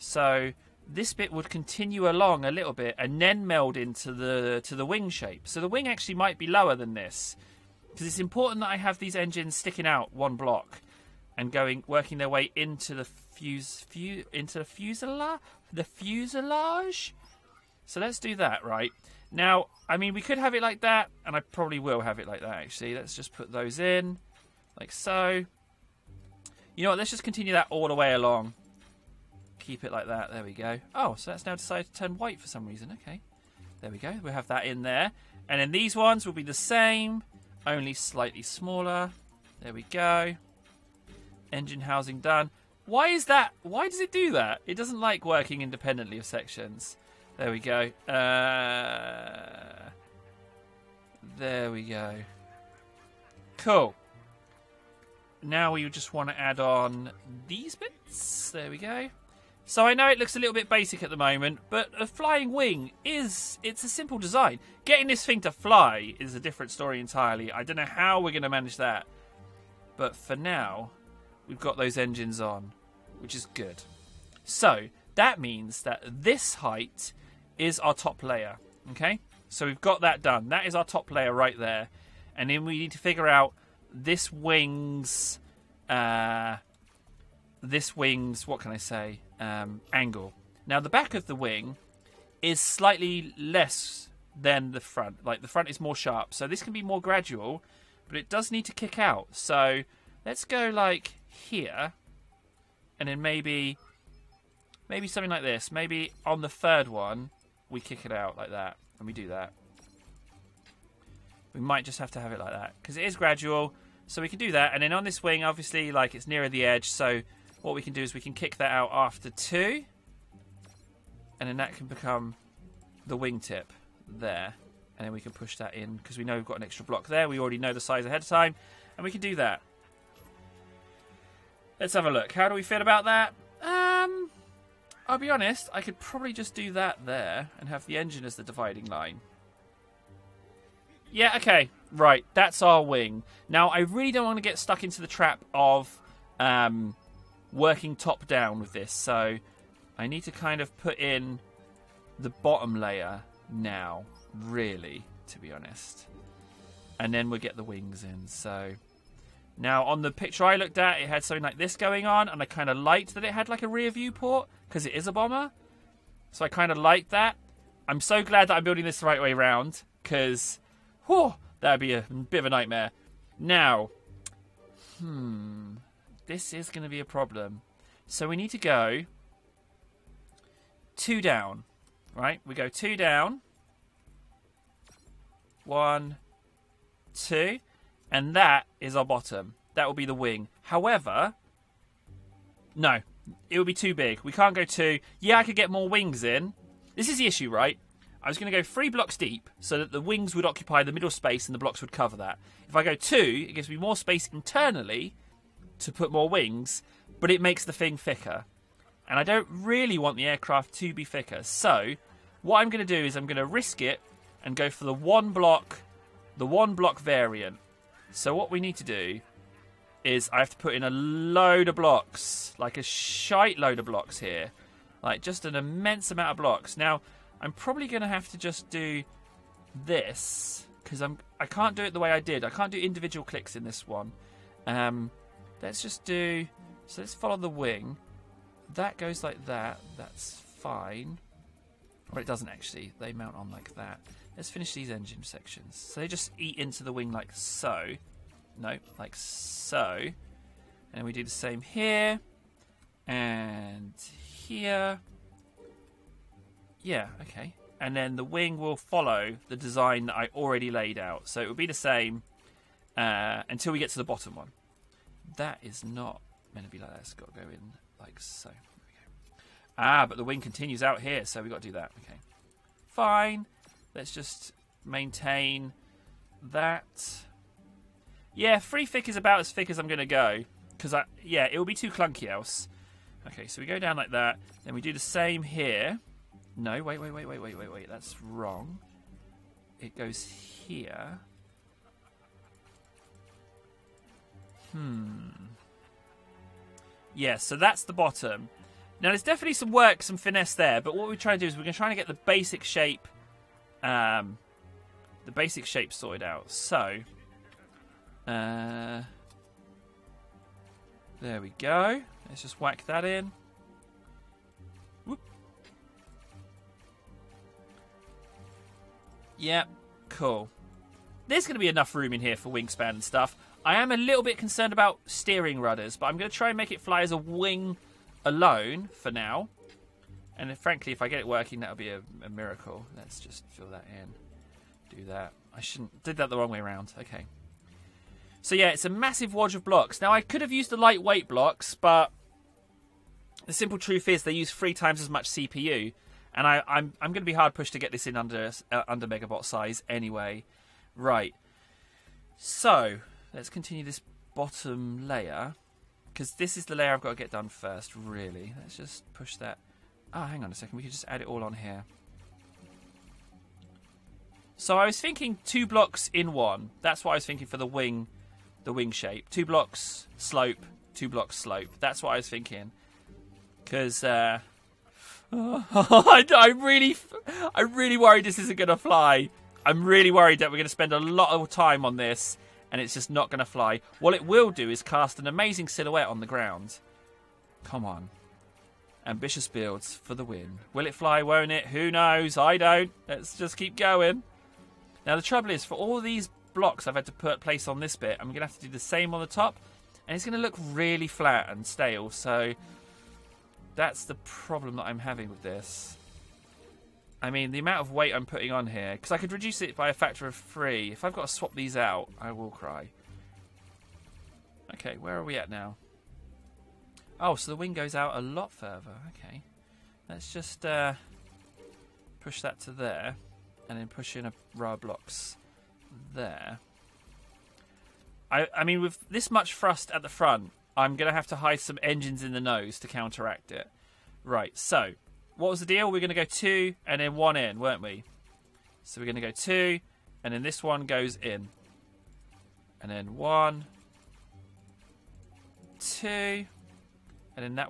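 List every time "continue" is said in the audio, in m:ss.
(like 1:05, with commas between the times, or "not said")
0:01, 0:27, 4:30, 5:53.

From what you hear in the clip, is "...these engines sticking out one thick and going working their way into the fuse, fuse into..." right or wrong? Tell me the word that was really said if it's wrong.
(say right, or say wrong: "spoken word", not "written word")
wrong: "block", not "thick".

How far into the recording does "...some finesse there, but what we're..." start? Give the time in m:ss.
5:00.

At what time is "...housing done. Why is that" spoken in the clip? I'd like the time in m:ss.
0:41.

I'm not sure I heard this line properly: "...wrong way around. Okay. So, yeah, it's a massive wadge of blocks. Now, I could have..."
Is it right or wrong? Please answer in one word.
right.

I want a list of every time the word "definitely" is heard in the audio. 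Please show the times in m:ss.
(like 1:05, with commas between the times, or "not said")
4:59.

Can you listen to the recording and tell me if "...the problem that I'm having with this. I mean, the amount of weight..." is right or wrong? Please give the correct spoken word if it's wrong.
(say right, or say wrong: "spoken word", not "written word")
right.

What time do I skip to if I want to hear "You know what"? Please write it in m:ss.
0:26.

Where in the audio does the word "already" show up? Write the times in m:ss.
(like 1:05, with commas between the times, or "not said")
2:07, 4:20.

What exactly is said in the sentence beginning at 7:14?
Right, so what was the deal?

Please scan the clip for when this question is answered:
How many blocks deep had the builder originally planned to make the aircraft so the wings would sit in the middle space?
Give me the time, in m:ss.
3:18.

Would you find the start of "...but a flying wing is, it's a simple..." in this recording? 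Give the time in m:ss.
1:01.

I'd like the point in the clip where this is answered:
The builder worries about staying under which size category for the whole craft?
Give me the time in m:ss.
5:49.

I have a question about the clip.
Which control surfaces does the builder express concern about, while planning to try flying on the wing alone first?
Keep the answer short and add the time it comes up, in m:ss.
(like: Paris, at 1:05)
steering rudders, at 5:25.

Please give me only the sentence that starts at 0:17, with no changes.
So let's do that right now.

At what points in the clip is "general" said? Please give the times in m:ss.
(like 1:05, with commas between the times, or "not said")
not said.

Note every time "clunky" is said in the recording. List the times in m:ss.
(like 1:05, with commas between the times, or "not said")
4:41.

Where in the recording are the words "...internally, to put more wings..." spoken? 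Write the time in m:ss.
3:24.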